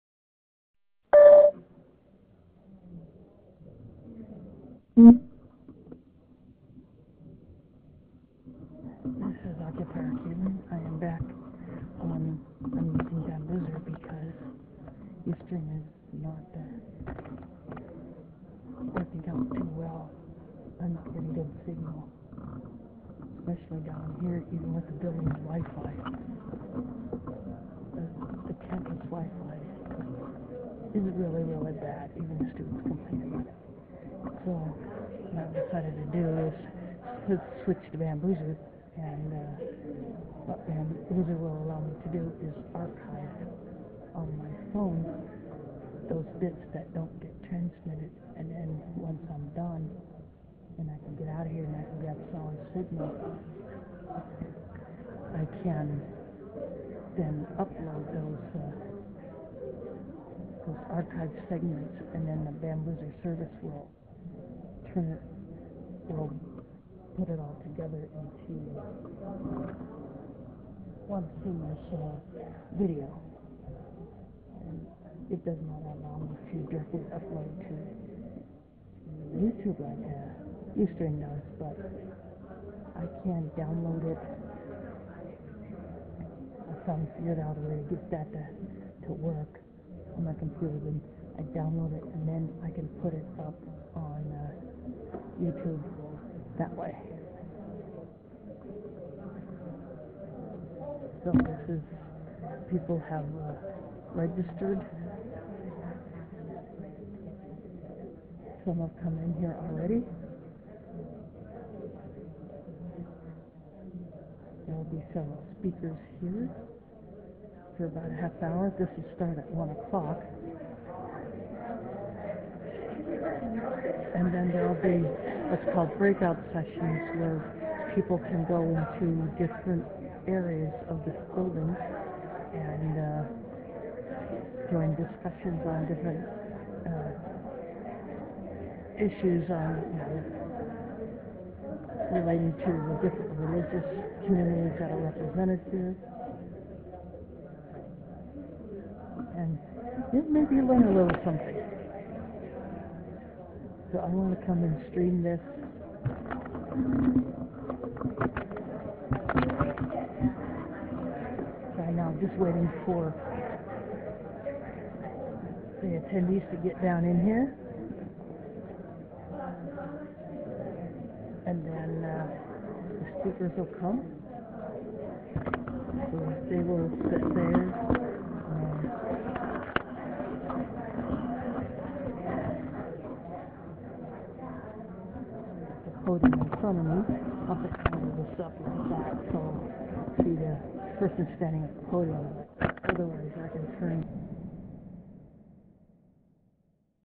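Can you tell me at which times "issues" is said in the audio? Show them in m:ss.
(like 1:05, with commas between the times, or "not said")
2:19.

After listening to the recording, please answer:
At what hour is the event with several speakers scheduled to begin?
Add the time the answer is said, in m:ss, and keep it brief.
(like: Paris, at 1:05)
1 o'clock, at 1:59.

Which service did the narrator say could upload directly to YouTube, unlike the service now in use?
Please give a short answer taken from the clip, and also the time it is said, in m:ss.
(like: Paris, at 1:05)
Ustream, at 1:20.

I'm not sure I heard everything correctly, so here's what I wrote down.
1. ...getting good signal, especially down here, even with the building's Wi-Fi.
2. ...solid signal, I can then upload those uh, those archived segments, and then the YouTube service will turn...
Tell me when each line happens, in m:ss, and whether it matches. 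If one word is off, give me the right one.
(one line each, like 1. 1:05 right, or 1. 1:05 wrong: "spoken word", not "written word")
1. 0:21 right
2. 0:52 wrong: "Bambuser", not "YouTube".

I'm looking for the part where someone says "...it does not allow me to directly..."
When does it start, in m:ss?
1:15.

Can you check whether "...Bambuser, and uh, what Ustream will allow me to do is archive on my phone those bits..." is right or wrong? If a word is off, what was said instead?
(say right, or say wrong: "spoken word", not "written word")
wrong: "Bambuser", not "Ustream".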